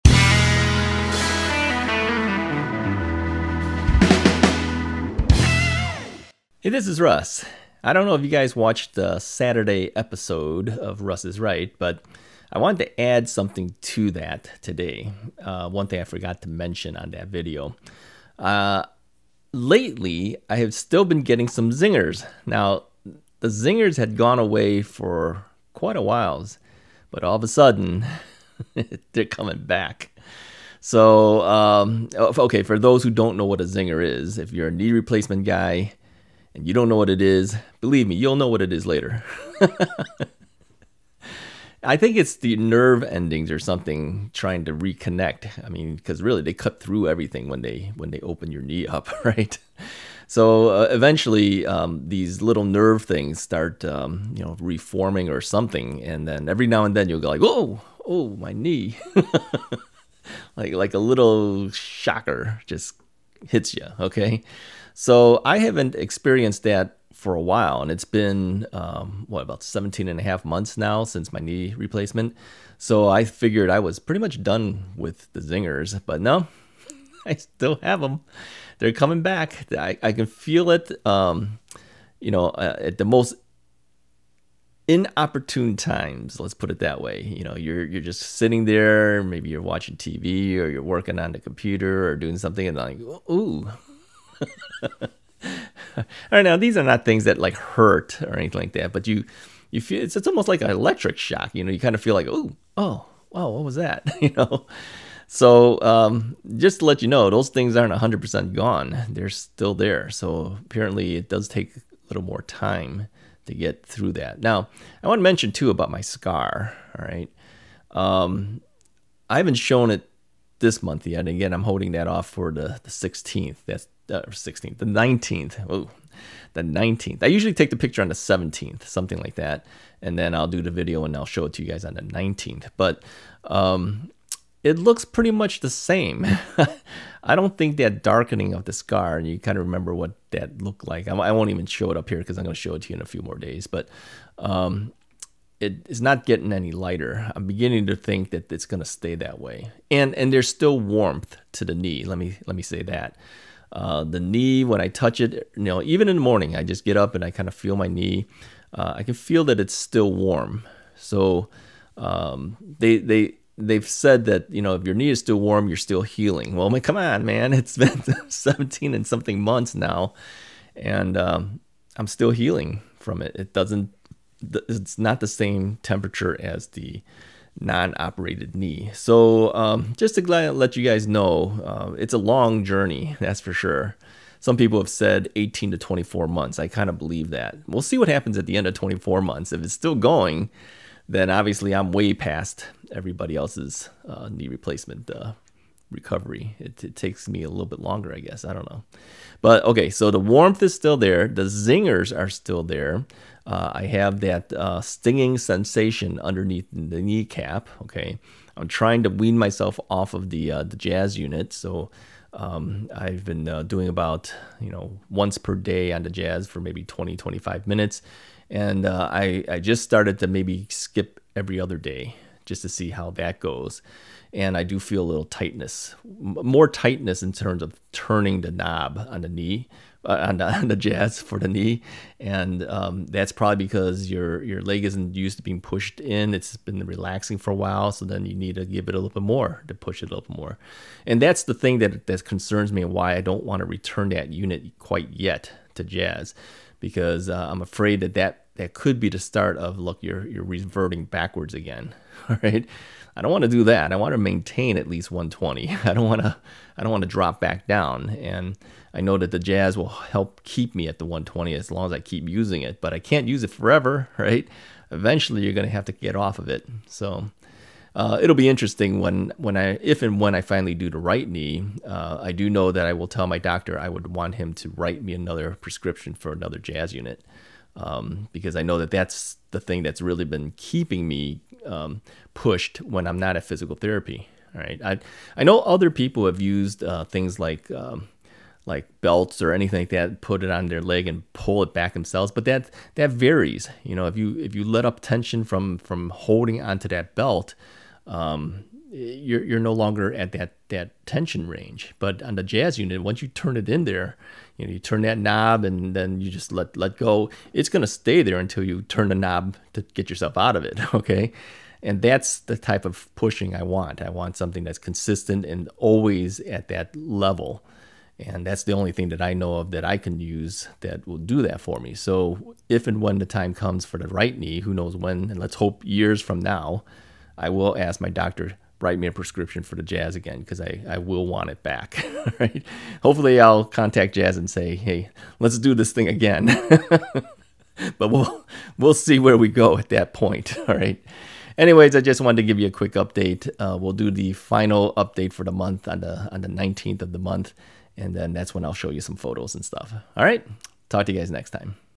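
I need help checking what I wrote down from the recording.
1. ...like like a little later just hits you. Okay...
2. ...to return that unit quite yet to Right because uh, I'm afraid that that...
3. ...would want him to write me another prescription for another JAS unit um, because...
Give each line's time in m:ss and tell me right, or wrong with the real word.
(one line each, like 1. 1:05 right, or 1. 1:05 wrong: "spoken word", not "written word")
1. 1:00 wrong: "shocker", not "later"
2. 4:03 wrong: "JAS", not "Right"
3. 4:33 right.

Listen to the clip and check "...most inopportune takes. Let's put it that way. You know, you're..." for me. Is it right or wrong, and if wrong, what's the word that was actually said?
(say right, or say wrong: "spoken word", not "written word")
wrong: "times", not "takes".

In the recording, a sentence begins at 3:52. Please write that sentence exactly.
And um, that's probably because your, your leg isn't used to being pushed in.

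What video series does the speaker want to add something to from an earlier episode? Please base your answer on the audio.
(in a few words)
Russ is Right.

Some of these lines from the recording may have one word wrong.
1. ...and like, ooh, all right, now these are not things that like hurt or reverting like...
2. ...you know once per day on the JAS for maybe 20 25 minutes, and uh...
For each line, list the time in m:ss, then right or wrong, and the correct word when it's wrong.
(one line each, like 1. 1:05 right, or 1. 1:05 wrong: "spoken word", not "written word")
1. 1:32 wrong: "anything", not "reverting"
2. 3:34 right.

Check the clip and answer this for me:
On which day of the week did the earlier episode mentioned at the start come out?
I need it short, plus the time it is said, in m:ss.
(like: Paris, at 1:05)
Saturday, at 0:09.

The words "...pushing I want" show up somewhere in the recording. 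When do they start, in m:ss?
5:13.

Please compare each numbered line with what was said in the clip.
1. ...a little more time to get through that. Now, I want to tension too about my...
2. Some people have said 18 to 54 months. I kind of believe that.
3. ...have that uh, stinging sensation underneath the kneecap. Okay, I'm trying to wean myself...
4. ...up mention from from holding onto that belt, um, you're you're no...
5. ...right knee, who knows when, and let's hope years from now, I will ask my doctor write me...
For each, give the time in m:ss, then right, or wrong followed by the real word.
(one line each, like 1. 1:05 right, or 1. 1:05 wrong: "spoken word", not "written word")
1. 1:51 wrong: "mention", not "tension"
2. 3:04 wrong: "24", not "54"
3. 3:23 right
4. 4:54 wrong: "tension", not "mention"
5. 5:24 right.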